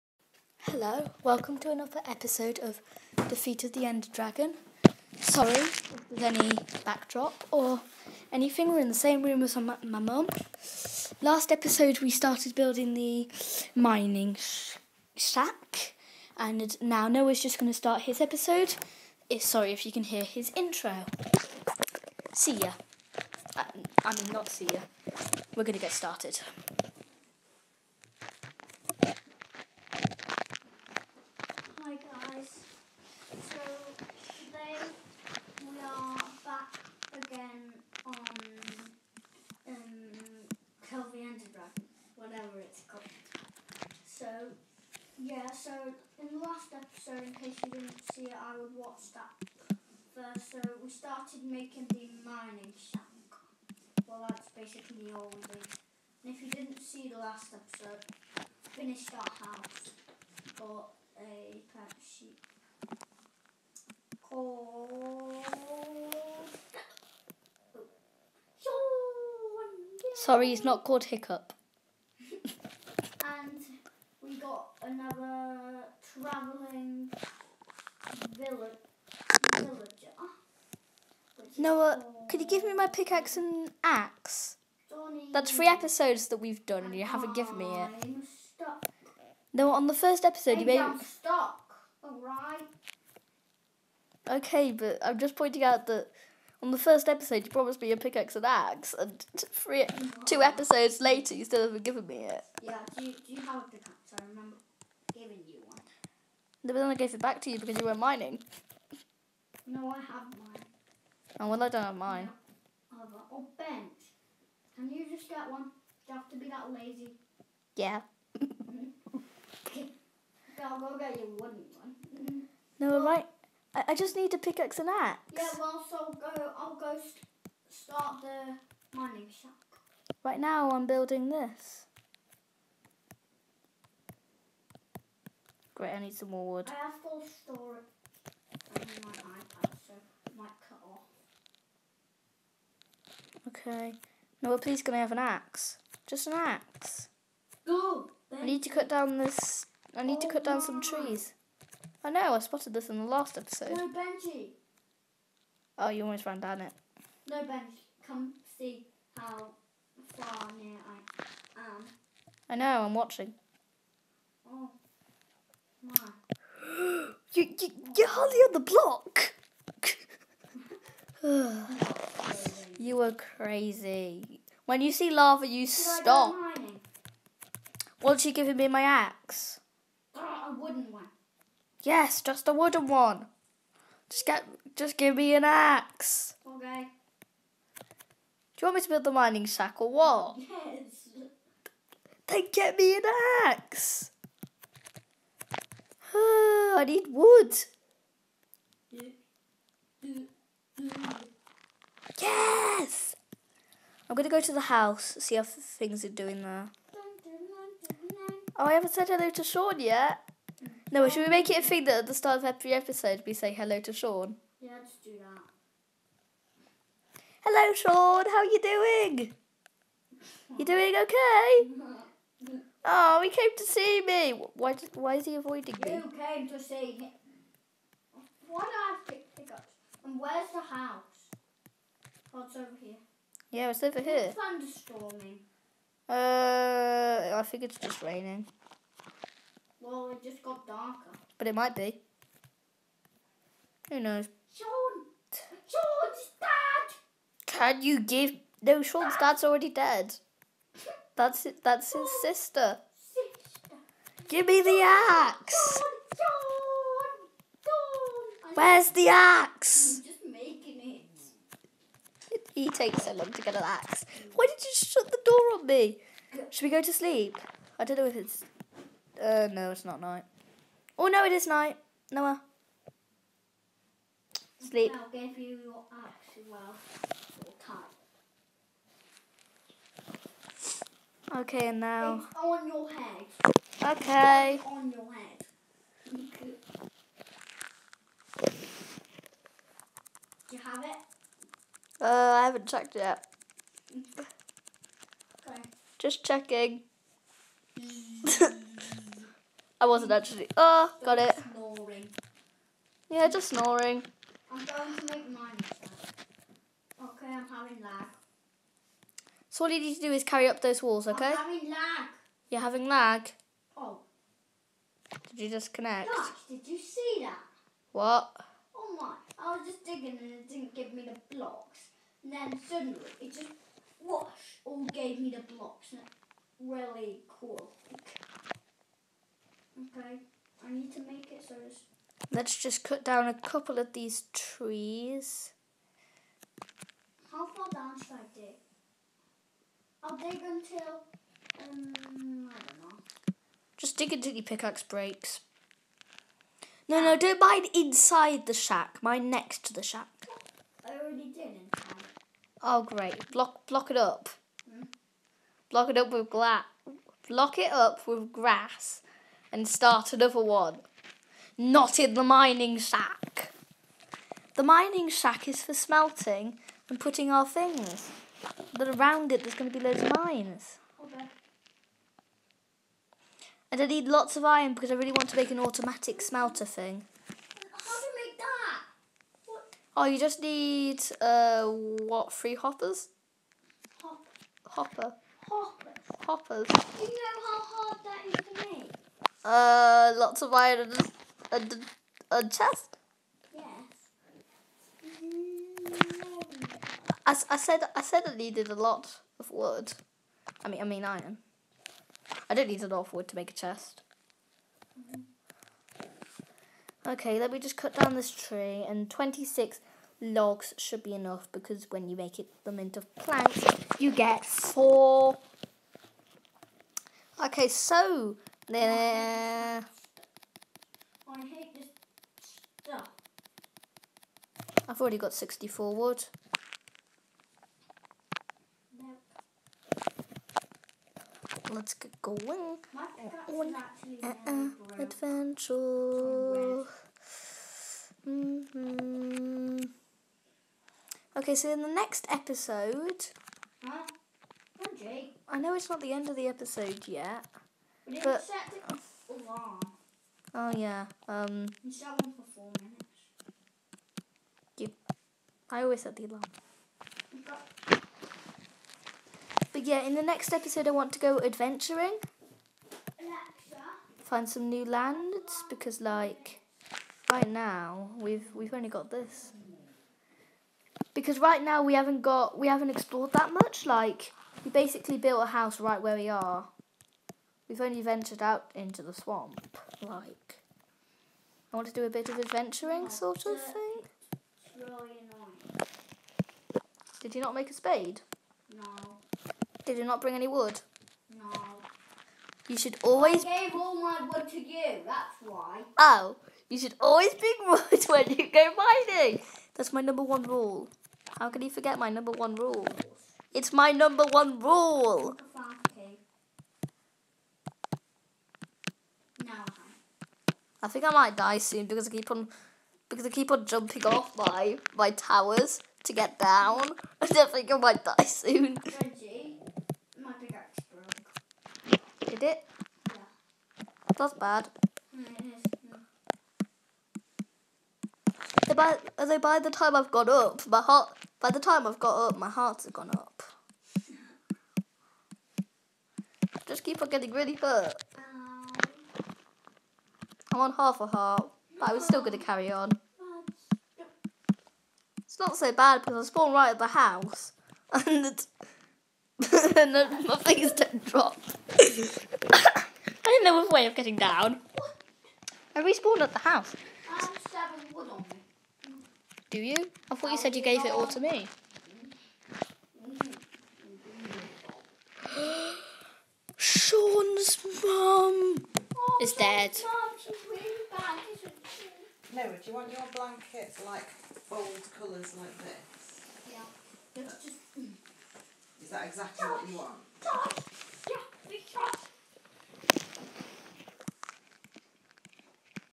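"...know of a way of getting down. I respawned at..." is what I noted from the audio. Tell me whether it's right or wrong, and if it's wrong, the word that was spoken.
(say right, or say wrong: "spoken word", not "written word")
right.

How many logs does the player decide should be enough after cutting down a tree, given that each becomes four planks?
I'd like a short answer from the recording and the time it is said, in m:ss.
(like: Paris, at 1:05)
26, at 6:49.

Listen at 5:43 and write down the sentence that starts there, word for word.
Just dig until your pickaxe breaks.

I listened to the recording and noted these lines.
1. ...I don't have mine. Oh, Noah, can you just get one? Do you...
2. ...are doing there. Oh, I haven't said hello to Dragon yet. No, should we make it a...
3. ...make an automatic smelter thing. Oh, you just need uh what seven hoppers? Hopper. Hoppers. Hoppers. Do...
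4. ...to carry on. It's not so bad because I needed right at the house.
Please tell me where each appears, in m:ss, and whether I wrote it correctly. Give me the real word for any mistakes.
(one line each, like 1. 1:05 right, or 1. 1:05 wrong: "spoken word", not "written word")
1. 1:51 wrong: "Bent", not "Noah"
2. 3:26 wrong: "Sean", not "Dragon"
3. 6:15 wrong: "three", not "seven"
4. 9:02 wrong: "spawned", not "needed".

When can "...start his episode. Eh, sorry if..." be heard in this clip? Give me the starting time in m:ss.
0:17.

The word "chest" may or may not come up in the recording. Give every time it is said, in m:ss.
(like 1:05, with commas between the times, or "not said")
6:32, 6:43.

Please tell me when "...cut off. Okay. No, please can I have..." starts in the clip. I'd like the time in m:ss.
2:20.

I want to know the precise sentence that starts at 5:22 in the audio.
And then suddenly it just whoosh all gave me the blocks.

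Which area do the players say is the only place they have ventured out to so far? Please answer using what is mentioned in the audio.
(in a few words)
the swamp.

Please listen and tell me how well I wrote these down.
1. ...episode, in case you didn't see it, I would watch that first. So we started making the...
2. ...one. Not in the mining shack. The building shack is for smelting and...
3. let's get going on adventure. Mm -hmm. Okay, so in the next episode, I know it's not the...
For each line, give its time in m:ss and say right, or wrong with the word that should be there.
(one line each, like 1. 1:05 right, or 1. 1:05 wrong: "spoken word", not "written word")
1. 0:46 right
2. 6:00 wrong: "mining", not "building"
3. 7:11 right.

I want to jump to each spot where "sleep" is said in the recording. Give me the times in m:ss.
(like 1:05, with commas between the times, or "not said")
4:26, 4:34.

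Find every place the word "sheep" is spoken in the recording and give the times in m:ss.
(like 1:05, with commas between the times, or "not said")
1:02.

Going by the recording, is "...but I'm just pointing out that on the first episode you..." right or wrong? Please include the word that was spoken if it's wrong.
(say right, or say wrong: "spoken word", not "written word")
right.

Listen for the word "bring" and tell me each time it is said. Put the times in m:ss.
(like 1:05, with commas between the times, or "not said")
8:10, 8:17.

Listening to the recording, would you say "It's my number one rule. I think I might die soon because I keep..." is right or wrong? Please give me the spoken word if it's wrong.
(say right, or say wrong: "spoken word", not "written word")
right.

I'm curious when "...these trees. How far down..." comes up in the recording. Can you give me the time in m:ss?
5:33.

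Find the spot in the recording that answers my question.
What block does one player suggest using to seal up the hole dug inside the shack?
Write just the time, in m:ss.
5:55.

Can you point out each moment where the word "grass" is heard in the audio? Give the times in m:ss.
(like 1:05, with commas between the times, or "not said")
5:58.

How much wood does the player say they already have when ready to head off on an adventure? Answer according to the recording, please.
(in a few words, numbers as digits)
64.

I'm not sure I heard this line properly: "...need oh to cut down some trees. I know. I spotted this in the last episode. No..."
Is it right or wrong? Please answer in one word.
right.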